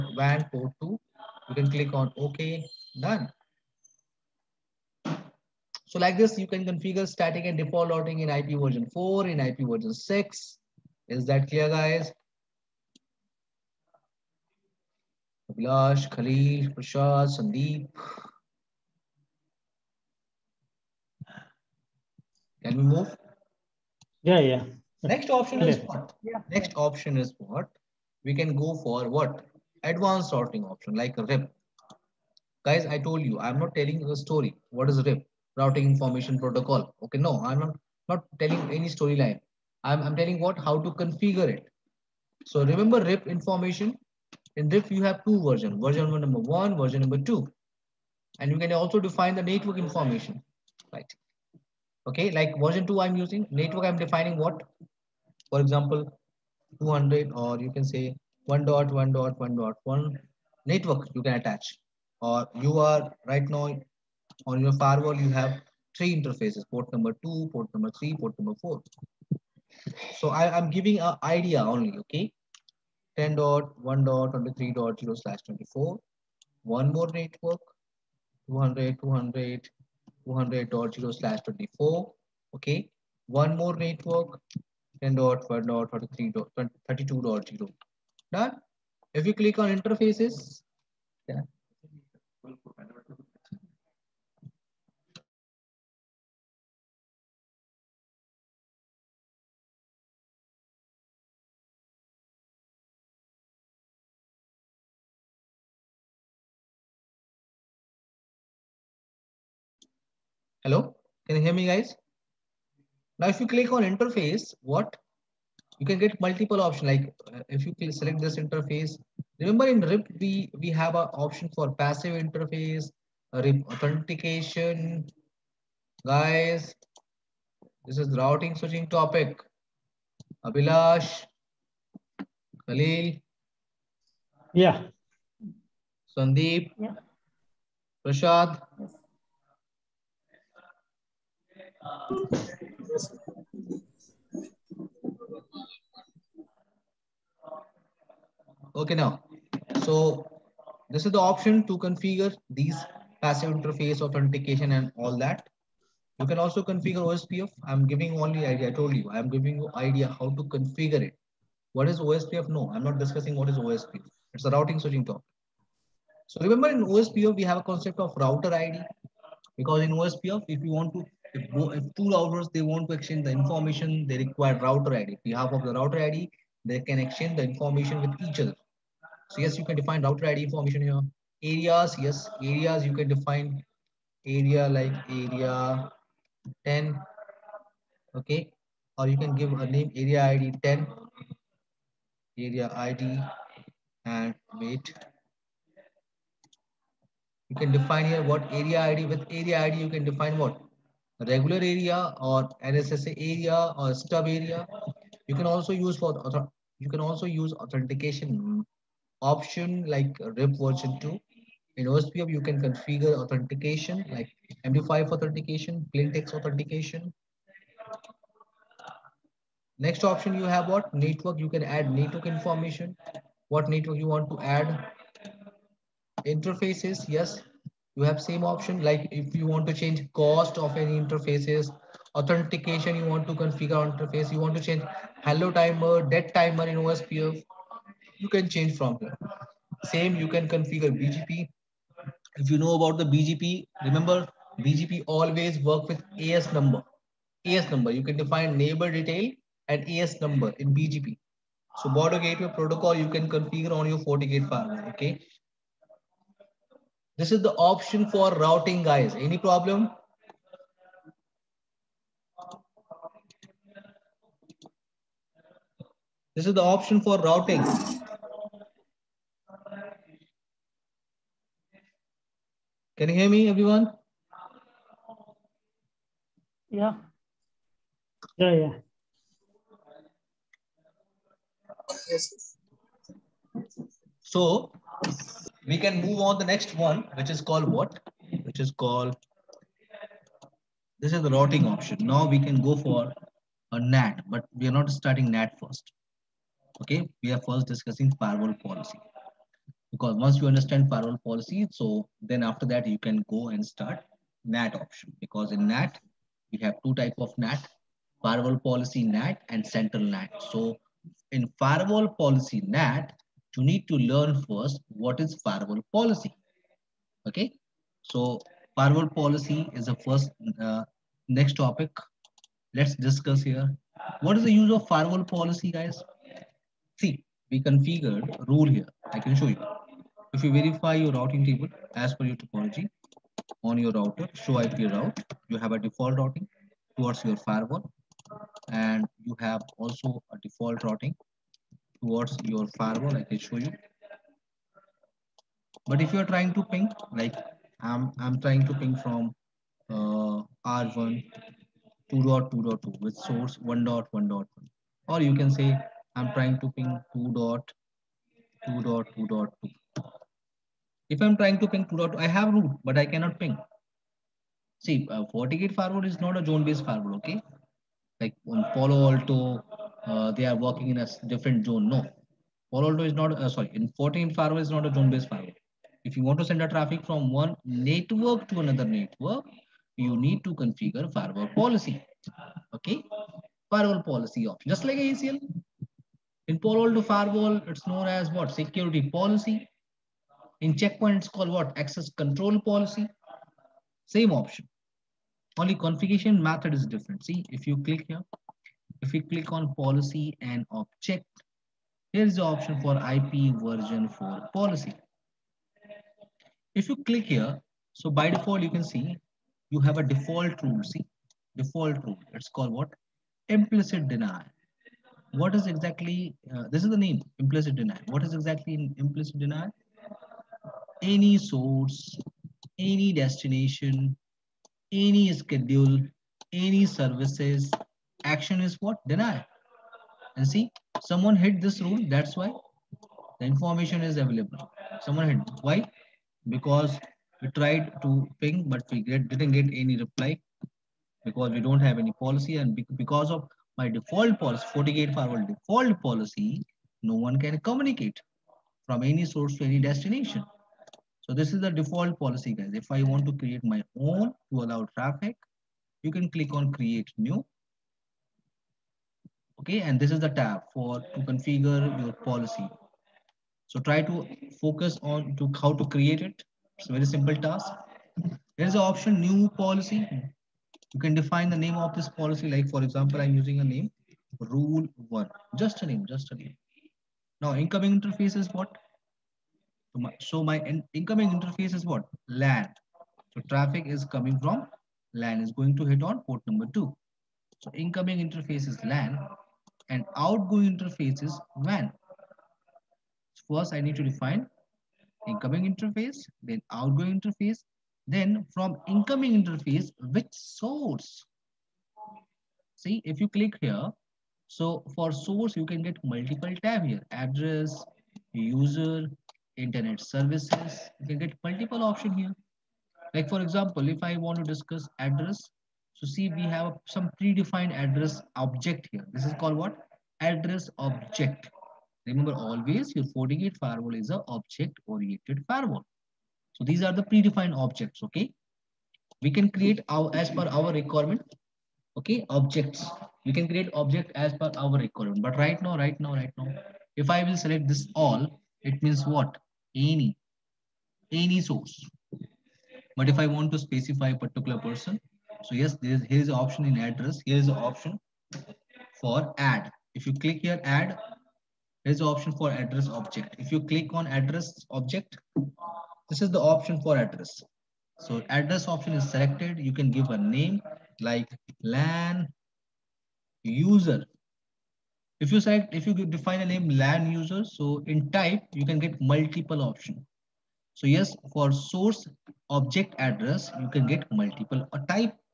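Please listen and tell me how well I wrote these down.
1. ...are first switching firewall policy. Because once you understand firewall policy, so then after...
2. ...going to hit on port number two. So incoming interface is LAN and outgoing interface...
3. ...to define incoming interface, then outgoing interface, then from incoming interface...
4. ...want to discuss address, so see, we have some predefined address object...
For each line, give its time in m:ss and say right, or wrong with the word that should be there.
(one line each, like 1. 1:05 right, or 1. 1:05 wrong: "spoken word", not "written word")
1. 4:57 wrong: "discussing", not "switching"
2. 8:05 right
3. 8:13 right
4. 8:34 right.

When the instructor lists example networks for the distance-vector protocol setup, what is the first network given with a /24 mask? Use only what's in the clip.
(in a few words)
10.1.23.0/24.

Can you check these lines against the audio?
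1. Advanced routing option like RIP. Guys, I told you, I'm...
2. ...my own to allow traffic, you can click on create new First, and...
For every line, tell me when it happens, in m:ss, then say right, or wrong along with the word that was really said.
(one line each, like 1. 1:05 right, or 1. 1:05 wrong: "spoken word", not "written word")
1. 0:29 right
2. 7:33 wrong: "Okay", not "First".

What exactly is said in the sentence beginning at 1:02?
Or you are right now on your firewall, you have three interfaces, port number two, port number three, port number four.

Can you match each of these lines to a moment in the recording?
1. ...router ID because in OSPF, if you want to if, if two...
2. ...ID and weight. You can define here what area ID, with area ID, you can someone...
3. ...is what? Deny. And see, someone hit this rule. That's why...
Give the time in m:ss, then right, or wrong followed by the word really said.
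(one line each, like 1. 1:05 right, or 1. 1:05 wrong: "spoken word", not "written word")
1. 2:48 right
2. 3:12 wrong: "define", not "someone"
3. 7:08 right.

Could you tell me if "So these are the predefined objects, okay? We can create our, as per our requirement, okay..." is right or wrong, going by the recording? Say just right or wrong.
right.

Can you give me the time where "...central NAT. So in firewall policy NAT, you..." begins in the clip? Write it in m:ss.
5:09.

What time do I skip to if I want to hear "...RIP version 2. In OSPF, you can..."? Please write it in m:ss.
3:30.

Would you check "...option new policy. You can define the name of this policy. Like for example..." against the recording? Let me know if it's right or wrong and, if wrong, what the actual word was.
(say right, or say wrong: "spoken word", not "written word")
right.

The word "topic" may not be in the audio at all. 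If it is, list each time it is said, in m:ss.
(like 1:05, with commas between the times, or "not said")
2:08, 2:45, 5:21.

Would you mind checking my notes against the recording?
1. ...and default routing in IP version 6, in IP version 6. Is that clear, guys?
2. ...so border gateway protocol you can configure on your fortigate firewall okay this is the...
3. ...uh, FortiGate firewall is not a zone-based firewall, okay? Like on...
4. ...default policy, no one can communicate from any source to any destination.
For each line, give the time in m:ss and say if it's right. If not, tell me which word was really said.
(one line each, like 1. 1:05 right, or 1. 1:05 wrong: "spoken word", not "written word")
1. 0:07 wrong: "4", not "6"
2. 4:11 right
3. 6:05 right
4. 7:25 right.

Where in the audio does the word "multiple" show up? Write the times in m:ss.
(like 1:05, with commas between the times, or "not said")
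1:56, 8:26, 8:31, 9:29, 9:34.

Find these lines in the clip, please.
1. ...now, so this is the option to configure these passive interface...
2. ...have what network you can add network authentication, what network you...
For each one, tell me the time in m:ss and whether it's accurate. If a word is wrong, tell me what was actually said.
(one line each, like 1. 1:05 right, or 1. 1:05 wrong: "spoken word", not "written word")
1. 2:28 right
2. 3:40 wrong: "information", not "authentication".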